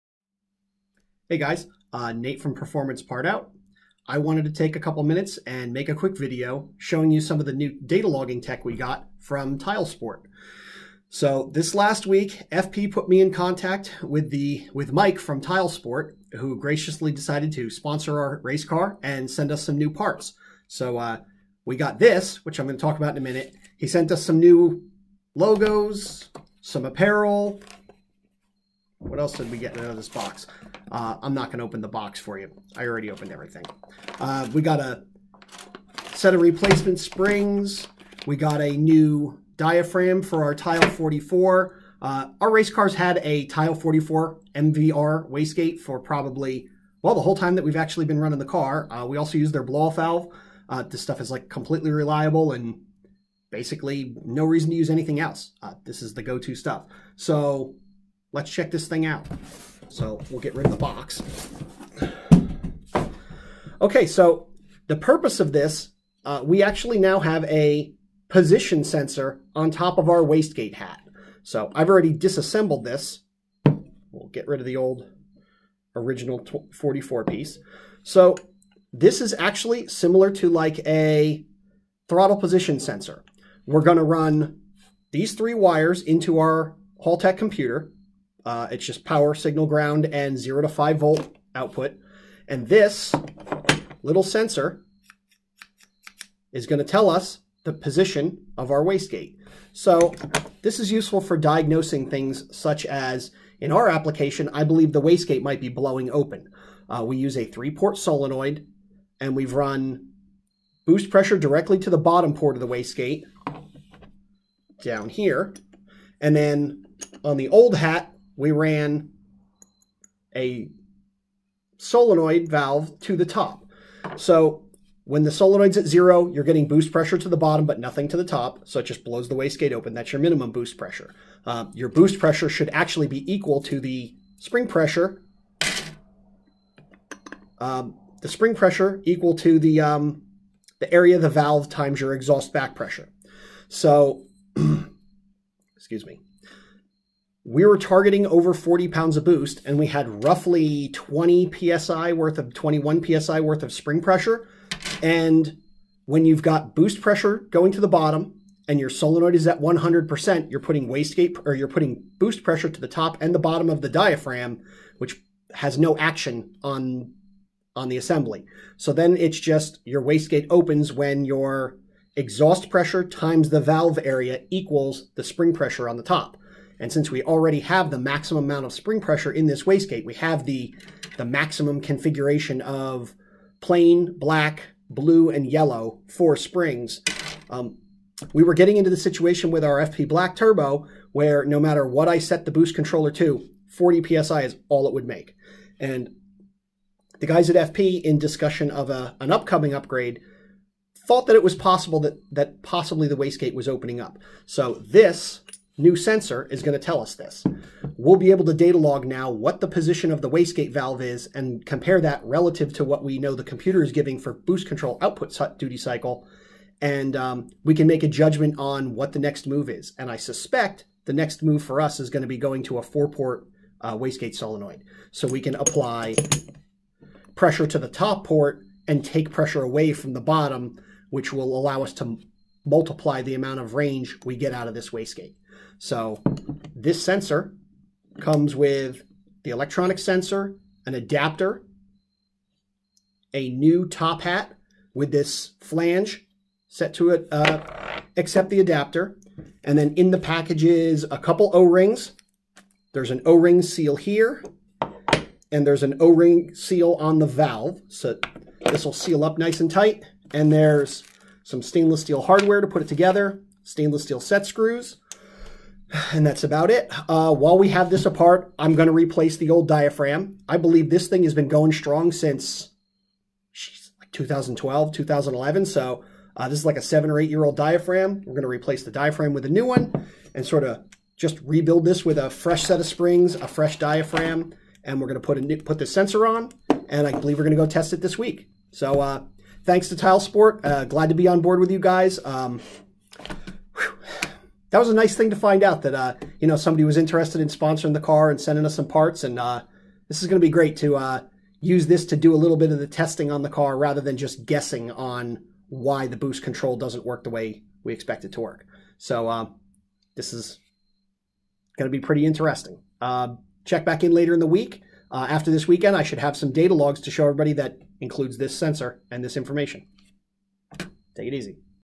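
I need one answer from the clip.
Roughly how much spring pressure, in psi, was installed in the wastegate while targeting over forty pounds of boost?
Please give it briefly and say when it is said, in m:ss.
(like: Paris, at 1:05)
21 psi, at 2:32.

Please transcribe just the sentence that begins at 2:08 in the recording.
So it just blows the wastegate open.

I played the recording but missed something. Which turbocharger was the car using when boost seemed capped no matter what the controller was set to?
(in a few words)
FP Black Turbo.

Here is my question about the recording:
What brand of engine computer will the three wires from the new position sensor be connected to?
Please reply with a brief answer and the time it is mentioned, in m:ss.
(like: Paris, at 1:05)
Haltech, at 1:27.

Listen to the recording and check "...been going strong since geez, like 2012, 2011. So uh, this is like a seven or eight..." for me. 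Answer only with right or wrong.
right.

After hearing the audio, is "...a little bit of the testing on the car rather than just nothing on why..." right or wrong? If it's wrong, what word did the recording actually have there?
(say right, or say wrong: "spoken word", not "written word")
wrong: "guessing", not "nothing".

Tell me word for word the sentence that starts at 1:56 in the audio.
And then on the old hat, we ran a solenoid valve to the top.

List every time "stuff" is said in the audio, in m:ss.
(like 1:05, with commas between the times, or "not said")
0:51, 0:56.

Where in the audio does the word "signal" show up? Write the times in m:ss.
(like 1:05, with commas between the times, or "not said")
1:29.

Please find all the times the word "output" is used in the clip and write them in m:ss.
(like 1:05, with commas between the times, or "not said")
1:31, 3:35.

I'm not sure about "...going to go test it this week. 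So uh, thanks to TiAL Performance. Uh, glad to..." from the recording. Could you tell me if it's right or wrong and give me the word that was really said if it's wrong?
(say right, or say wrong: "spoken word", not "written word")
wrong: "Sport", not "Performance".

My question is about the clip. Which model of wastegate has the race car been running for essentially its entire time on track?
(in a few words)
TiAL 44 MVR.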